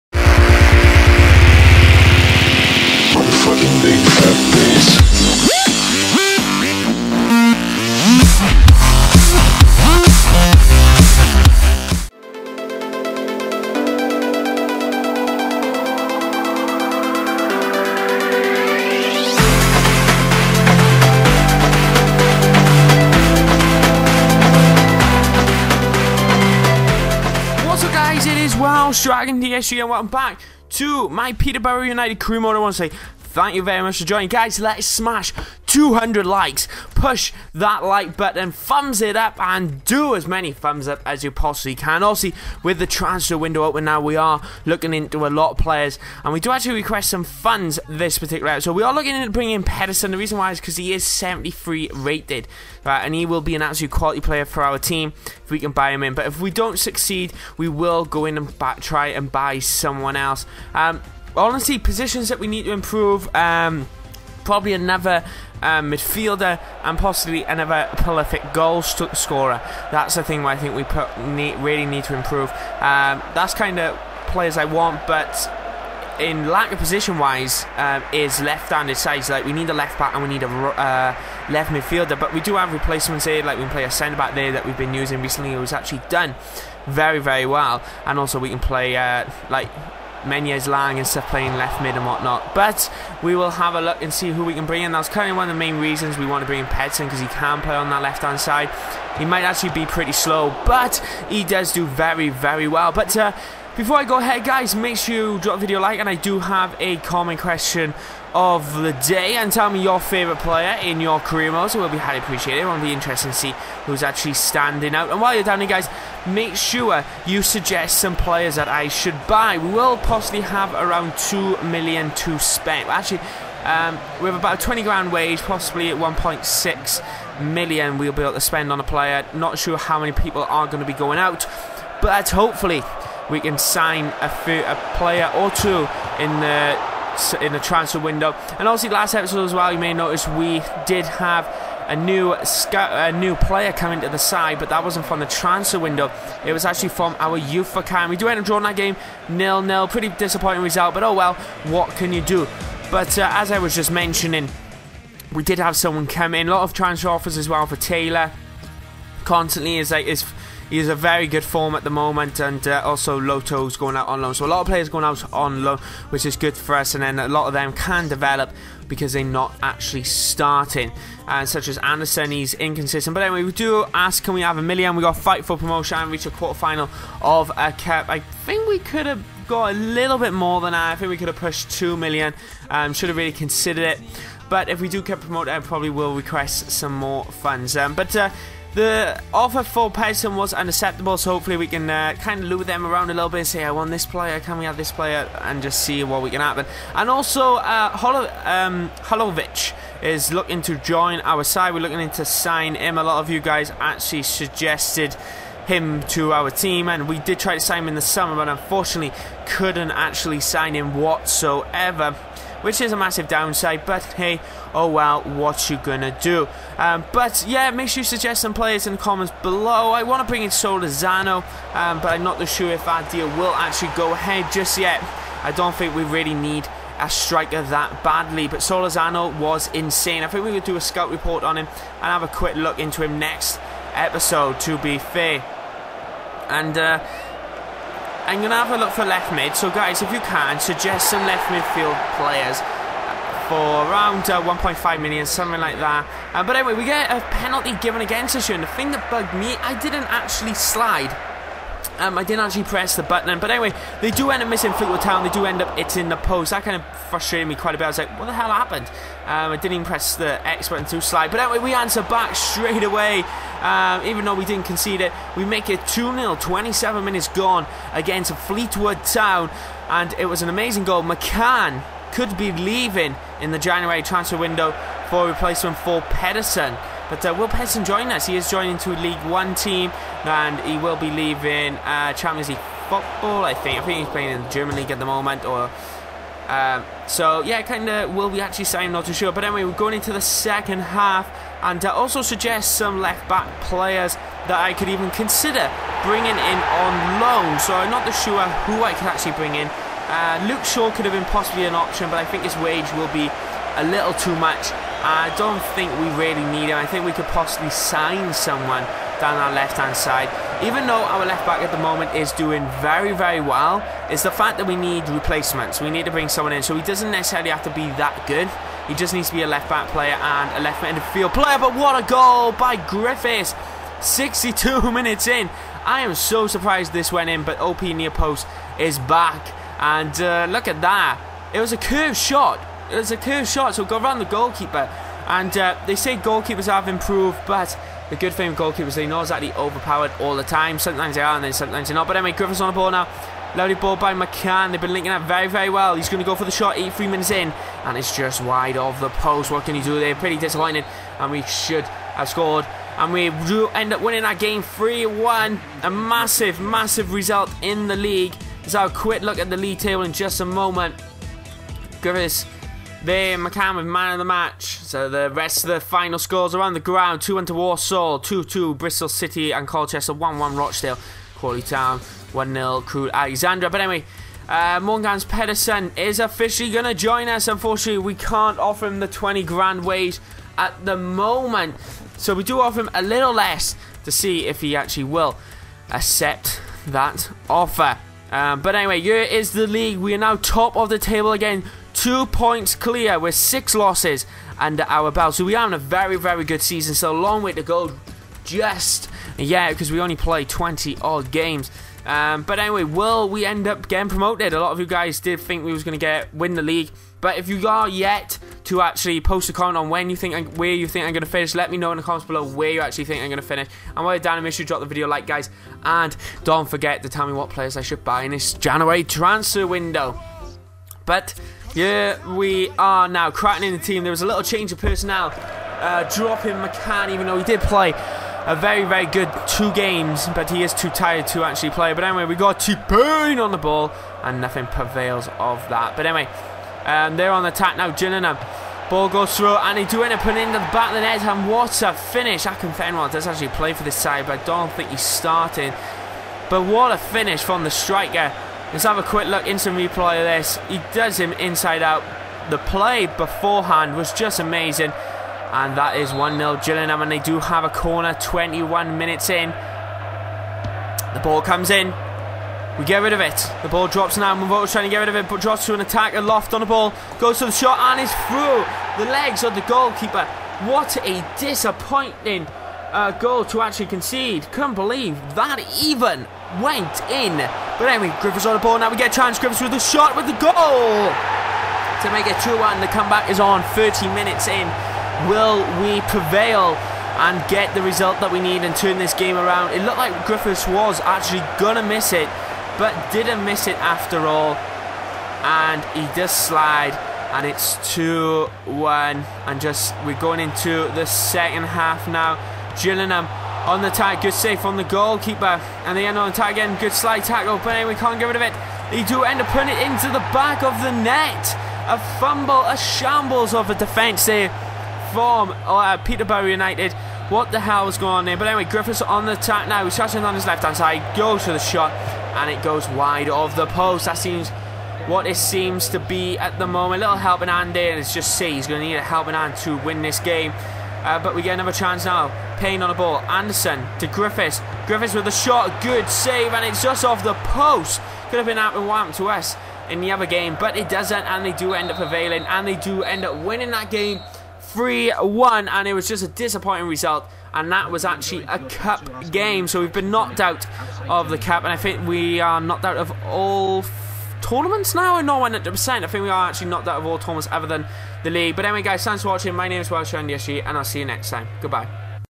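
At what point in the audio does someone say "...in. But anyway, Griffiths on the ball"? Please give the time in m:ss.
7:57.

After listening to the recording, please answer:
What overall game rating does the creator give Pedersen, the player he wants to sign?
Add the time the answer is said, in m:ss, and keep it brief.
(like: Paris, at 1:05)
73, at 0:51.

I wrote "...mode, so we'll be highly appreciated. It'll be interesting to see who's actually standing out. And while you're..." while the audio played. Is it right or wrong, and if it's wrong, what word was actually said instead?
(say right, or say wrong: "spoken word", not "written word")
right.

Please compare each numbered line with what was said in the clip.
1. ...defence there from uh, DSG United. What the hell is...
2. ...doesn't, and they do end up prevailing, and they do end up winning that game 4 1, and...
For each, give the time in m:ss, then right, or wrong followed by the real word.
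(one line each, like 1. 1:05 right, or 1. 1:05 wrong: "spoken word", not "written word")
1. 8:33 wrong: "Peterborough", not "DSG"
2. 9:00 wrong: "3", not "4".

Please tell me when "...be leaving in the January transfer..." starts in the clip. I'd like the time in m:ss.
4:32.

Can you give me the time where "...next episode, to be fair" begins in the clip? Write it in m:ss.
3:53.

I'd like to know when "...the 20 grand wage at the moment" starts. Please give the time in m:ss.
6:18.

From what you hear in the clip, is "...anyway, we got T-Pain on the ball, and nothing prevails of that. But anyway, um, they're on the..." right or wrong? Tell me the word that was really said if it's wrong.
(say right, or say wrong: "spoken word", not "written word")
right.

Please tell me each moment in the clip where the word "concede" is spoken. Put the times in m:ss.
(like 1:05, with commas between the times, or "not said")
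4:24, 7:53.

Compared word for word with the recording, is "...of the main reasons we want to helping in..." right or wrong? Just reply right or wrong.
wrong.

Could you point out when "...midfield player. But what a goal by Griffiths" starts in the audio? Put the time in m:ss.
5:20.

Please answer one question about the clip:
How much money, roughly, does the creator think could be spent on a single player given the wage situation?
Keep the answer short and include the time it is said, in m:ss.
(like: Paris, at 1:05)
1.6 million, at 2:05.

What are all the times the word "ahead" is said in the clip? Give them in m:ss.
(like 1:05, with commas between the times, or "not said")
1:44, 3:44.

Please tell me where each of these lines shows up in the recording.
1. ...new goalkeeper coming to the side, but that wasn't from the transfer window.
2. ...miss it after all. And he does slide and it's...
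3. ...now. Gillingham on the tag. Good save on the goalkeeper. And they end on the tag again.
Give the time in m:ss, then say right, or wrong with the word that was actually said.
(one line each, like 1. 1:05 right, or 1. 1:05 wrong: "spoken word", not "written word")
1. 2:23 wrong: "player", not "goalkeeper"
2. 8:13 right
3. 8:22 right.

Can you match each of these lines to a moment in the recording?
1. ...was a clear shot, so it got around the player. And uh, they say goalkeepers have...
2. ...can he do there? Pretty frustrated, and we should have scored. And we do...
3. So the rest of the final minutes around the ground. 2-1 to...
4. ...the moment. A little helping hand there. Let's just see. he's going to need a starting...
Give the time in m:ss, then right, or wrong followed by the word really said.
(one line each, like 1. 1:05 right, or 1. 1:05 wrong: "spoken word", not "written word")
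1. 5:32 wrong: "goalkeeper", not "player"
2. 5:49 wrong: "disappointed", not "frustrated"
3. 6:04 wrong: "scores", not "minutes"
4. 8:46 wrong: "helping", not "starting".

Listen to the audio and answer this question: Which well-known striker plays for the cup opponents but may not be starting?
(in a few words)
Akinfenwa.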